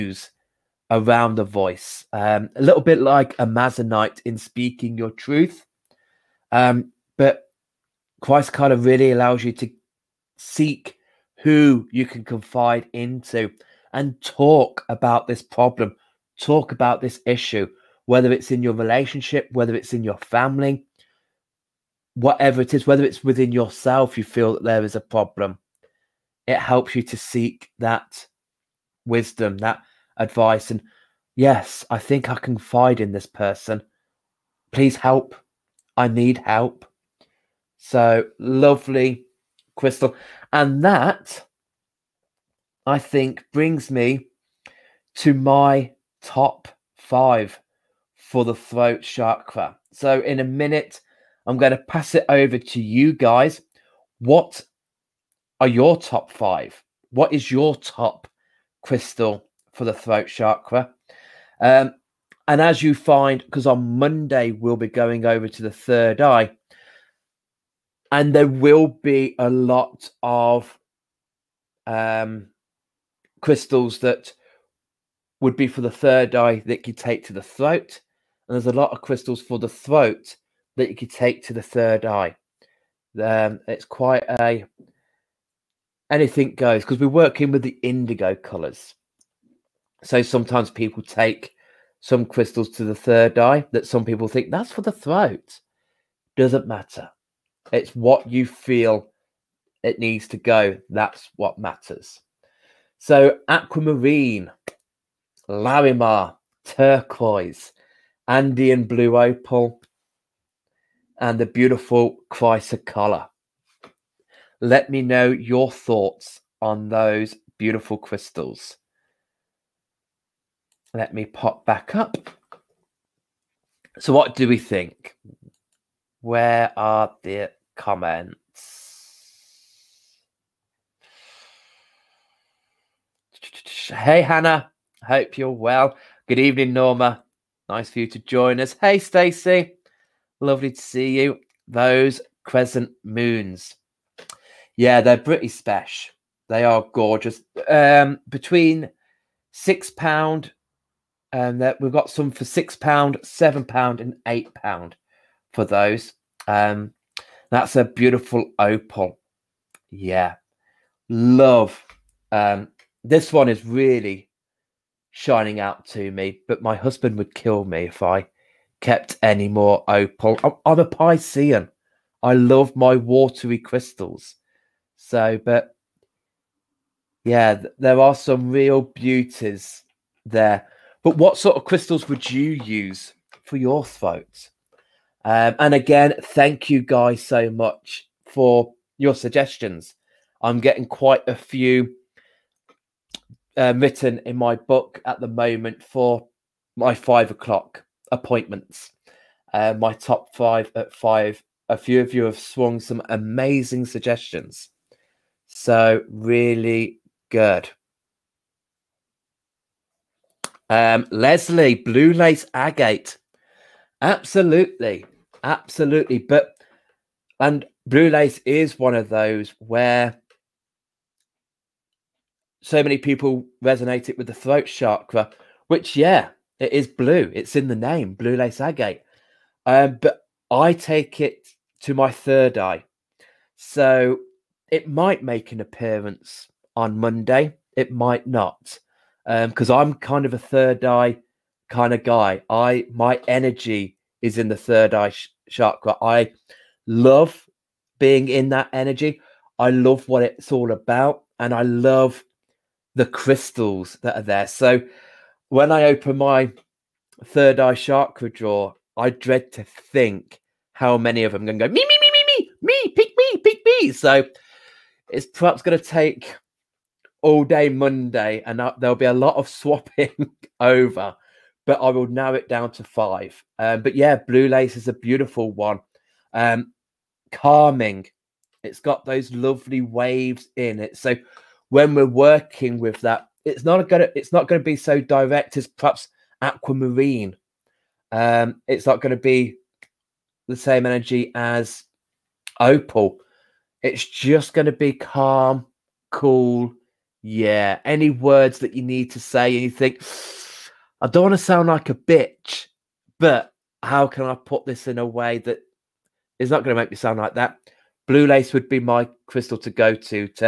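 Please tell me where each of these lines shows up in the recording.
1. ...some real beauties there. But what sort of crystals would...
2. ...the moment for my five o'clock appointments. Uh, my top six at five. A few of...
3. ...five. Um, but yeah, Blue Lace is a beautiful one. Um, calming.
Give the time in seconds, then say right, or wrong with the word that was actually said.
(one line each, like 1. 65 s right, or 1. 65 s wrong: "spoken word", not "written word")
1. 178 s right
2. 195 s wrong: "five", not "six"
3. 272 s right.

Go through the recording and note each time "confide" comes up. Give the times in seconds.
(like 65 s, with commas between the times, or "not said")
12 s, 32 s.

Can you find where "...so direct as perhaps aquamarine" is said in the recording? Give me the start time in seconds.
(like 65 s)
284 s.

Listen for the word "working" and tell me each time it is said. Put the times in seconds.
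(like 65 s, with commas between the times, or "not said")
87 s, 282 s.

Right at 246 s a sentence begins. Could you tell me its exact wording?
I love being in that energy.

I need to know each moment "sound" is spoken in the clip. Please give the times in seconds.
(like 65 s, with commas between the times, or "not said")
301 s, 306 s.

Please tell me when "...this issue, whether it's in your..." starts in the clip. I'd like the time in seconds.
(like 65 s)
16 s.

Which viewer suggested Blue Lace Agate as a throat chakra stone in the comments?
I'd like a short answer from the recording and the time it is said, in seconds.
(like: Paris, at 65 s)
Leslie, at 211 s.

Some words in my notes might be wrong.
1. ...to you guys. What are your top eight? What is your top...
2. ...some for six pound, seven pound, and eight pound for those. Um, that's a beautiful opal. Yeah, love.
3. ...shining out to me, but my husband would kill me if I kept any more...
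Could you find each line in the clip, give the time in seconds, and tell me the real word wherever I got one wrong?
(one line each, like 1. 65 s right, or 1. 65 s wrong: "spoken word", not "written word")
1. 52 s wrong: "five", not "eight"
2. 152 s right
3. 165 s right.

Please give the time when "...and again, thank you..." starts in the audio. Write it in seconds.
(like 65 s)
185 s.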